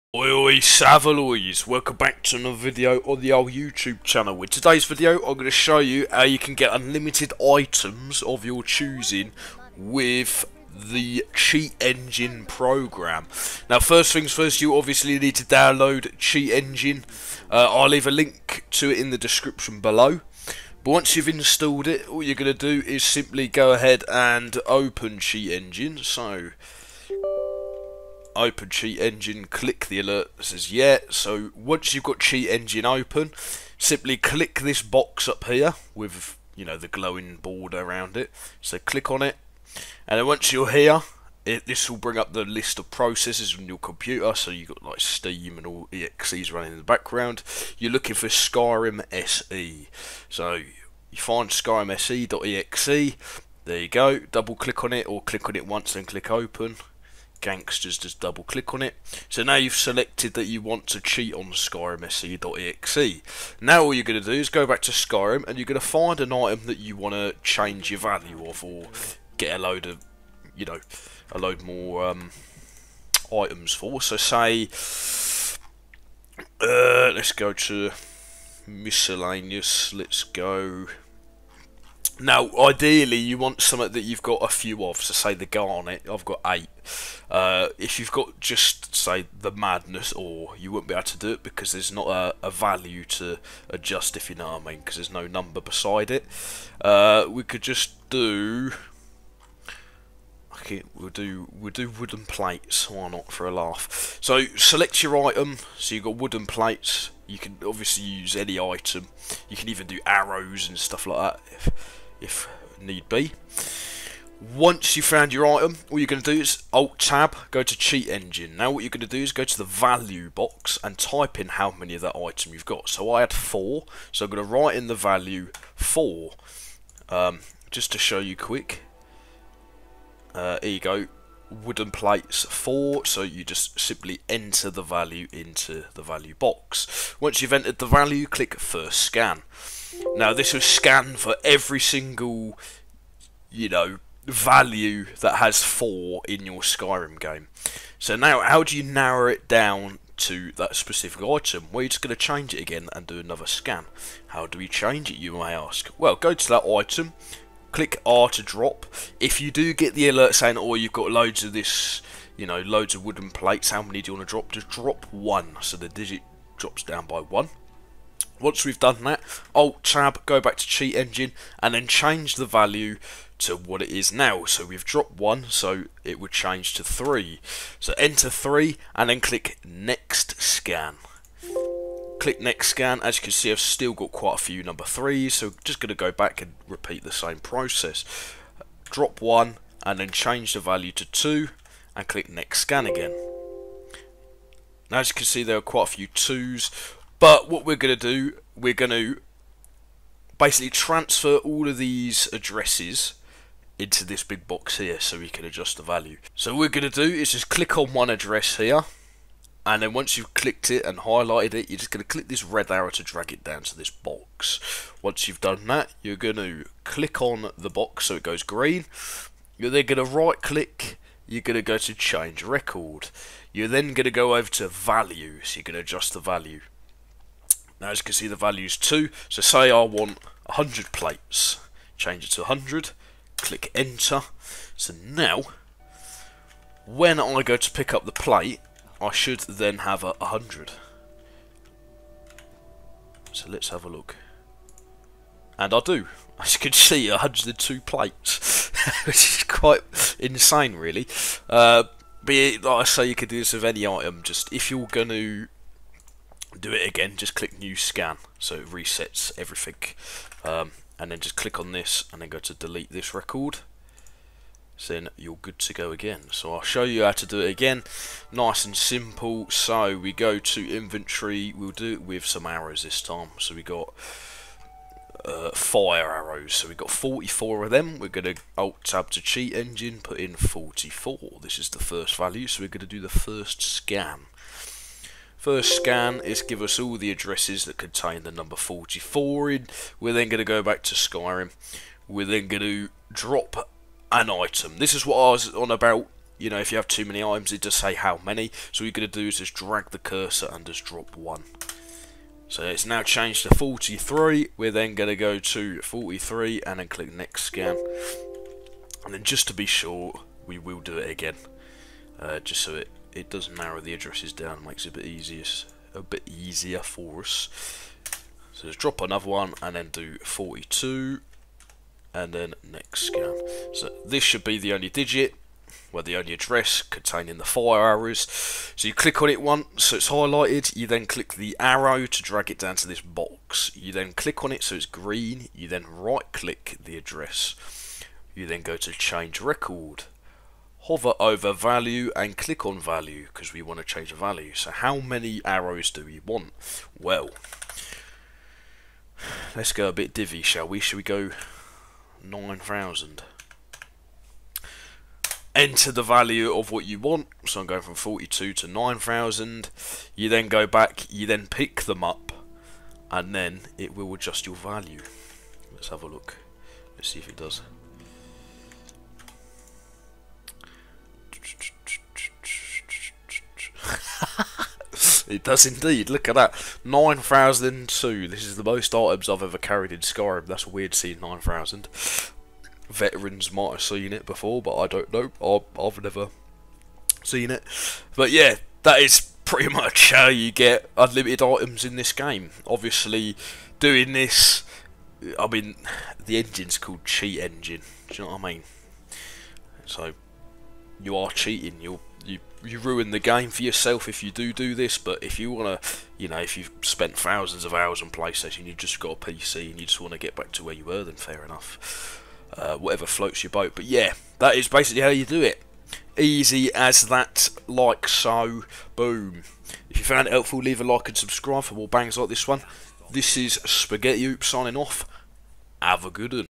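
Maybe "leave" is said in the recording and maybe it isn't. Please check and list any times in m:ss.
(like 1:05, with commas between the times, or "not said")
0:17, 7:00.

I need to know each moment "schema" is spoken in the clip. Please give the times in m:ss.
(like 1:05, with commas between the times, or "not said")
not said.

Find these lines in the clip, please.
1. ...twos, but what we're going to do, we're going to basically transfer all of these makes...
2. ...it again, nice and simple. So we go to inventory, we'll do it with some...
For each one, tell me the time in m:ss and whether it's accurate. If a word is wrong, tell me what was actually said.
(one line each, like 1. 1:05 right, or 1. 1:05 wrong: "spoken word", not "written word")
1. 3:16 wrong: "addresses", not "makes"
2. 4:27 right.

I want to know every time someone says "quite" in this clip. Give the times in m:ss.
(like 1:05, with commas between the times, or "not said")
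3:04, 3:15, 4:09.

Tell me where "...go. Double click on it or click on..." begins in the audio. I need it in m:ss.
0:53.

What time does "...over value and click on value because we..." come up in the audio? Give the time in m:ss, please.
5:41.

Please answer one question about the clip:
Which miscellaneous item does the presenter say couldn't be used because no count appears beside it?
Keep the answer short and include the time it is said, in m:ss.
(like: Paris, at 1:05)
Madness Ore, at 1:29.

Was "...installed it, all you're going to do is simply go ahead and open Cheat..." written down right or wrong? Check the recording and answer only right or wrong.
right.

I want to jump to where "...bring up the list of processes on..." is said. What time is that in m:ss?
0:41.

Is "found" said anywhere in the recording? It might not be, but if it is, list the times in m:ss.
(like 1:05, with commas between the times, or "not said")
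1:55, 7:00.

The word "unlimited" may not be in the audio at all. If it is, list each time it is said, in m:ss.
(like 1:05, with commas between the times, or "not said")
0:06, 6:30.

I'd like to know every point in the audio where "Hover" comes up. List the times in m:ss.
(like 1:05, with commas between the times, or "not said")
5:40.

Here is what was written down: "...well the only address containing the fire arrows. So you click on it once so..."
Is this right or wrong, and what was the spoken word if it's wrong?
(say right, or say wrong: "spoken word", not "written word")
right.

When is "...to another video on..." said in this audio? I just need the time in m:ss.
0:02.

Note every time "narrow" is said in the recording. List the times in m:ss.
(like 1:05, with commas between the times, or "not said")
2:28, 5:13.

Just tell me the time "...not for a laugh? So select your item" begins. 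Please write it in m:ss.
1:43.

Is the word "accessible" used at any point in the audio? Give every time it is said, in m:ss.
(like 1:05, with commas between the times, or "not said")
not said.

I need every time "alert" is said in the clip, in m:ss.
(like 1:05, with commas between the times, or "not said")
0:29, 2:40.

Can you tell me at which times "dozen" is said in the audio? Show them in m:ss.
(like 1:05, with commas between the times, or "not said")
not said.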